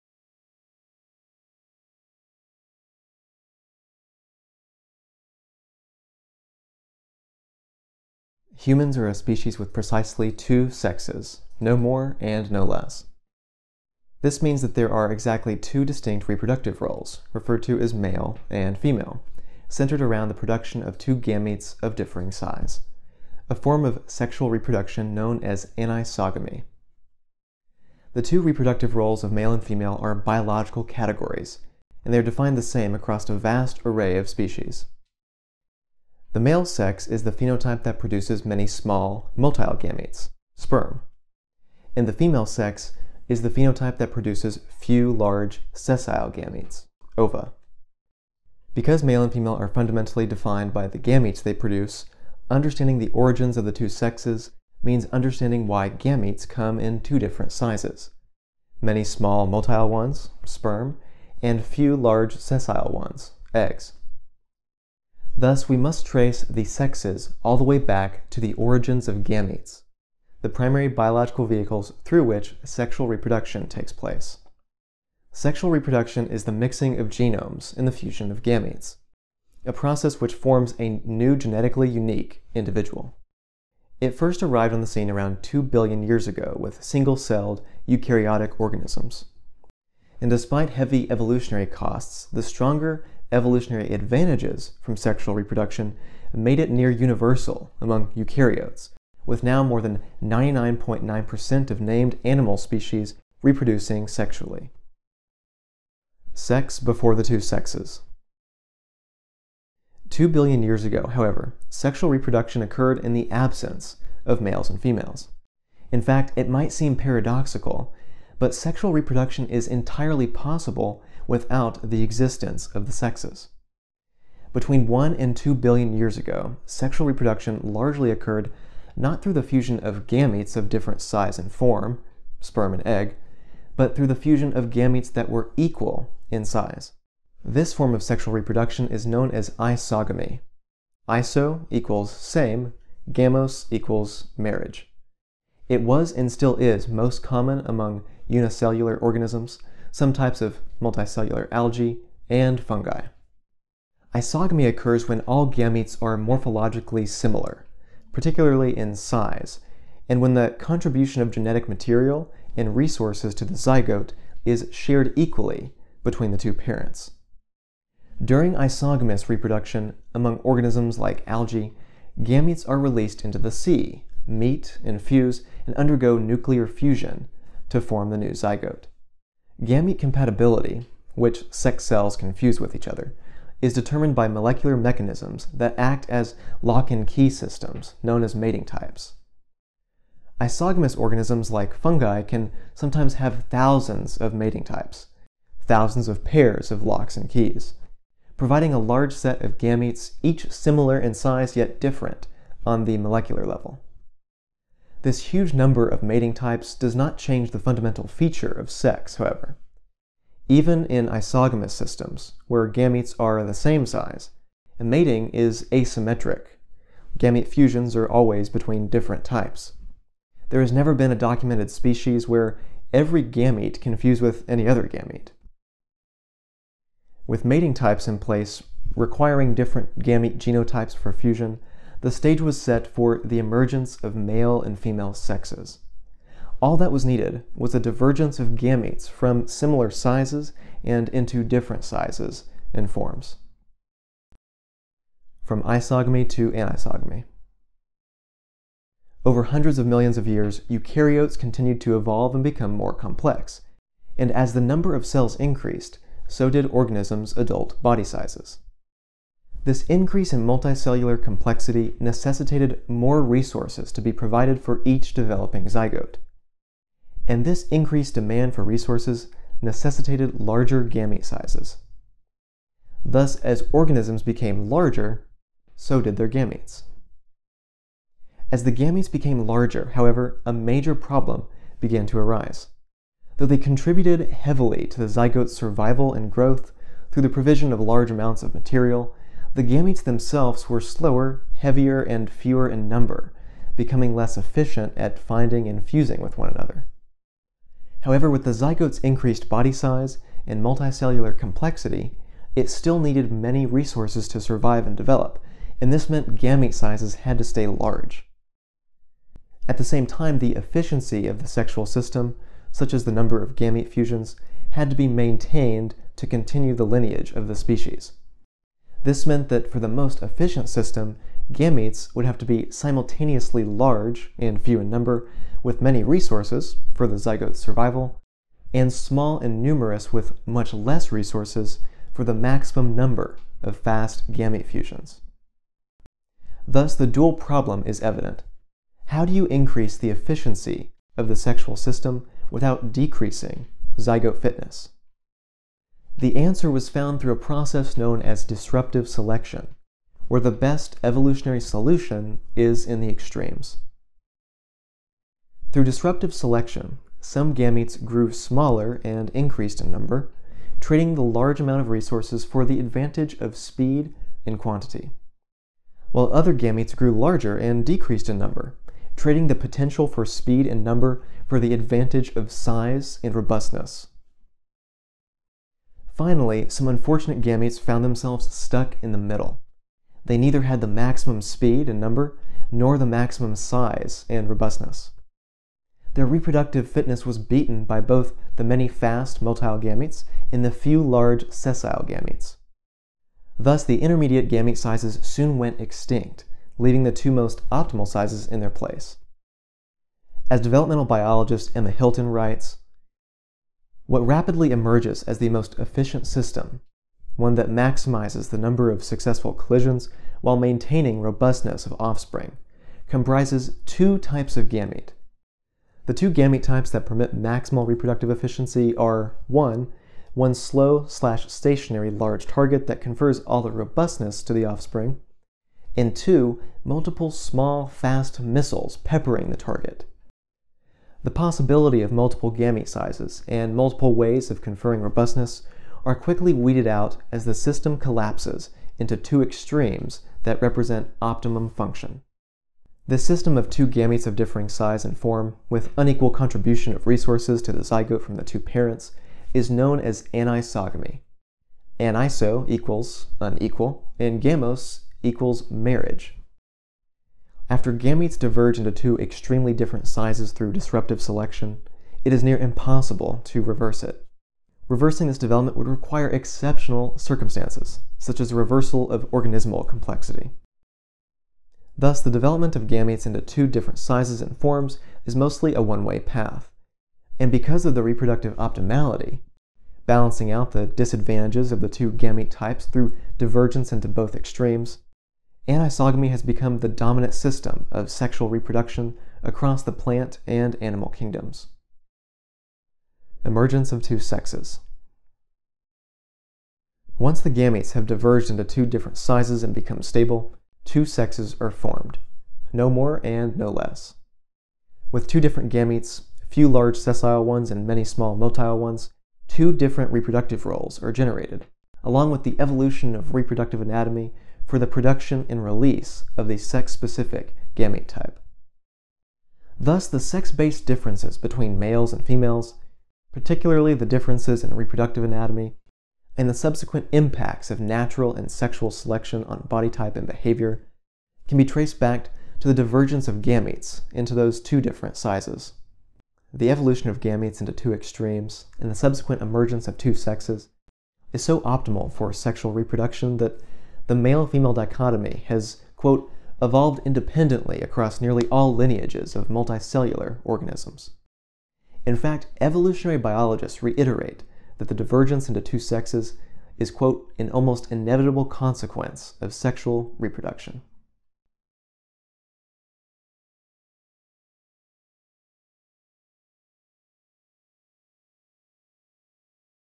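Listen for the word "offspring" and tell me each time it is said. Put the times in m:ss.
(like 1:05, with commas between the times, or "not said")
6:51, 7:04.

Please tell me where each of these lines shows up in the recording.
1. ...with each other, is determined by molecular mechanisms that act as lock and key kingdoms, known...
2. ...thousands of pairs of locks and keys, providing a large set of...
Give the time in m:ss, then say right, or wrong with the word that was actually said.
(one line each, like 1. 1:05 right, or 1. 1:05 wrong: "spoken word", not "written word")
1. 3:02 wrong: "systems", not "kingdoms"
2. 3:15 right.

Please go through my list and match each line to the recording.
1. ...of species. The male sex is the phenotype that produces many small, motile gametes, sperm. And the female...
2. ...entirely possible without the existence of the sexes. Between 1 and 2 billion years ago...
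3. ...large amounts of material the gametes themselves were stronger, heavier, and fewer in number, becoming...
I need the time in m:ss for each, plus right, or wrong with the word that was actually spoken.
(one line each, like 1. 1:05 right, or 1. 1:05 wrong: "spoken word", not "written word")
1. 0:34 right
2. 1:59 right
3. 4:47 wrong: "slower", not "stronger".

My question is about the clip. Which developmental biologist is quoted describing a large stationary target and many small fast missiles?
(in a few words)
Emma Hilton.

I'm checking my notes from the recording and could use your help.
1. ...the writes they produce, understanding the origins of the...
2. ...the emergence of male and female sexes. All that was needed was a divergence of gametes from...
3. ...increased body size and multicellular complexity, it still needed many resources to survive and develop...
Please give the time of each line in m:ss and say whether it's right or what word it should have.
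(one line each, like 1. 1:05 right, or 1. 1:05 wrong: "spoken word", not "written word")
1. 0:50 wrong: "gametes", not "writes"
2. 3:53 right
3. 4:58 right.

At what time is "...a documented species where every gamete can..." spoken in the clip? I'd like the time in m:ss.
3:41.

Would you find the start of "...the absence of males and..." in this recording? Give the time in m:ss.
1:53.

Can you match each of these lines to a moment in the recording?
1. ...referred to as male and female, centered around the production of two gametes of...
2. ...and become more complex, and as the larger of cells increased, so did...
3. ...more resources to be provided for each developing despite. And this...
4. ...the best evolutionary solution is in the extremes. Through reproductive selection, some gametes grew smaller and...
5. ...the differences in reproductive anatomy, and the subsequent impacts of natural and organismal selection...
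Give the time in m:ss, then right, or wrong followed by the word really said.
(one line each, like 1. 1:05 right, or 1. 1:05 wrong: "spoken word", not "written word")
1. 0:17 right
2. 4:12 wrong: "number", not "larger"
3. 4:22 wrong: "zygote", not "despite"
4. 5:50 wrong: "disruptive", not "reproductive"
5. 8:43 wrong: "sexual", not "organismal".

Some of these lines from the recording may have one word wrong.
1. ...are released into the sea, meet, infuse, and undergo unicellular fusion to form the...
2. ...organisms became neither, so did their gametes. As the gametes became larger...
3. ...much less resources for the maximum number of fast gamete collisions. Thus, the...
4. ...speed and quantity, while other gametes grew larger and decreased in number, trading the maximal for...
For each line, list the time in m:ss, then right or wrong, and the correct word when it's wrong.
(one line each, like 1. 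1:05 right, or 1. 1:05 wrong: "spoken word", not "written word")
1. 2:52 wrong: "nuclear", not "unicellular"
2. 4:33 wrong: "larger", not "neither"
3. 5:30 wrong: "fusions", not "collisions"
4. 6:03 wrong: "potential", not "maximal".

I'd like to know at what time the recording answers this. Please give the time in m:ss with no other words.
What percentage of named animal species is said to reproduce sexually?
1:39.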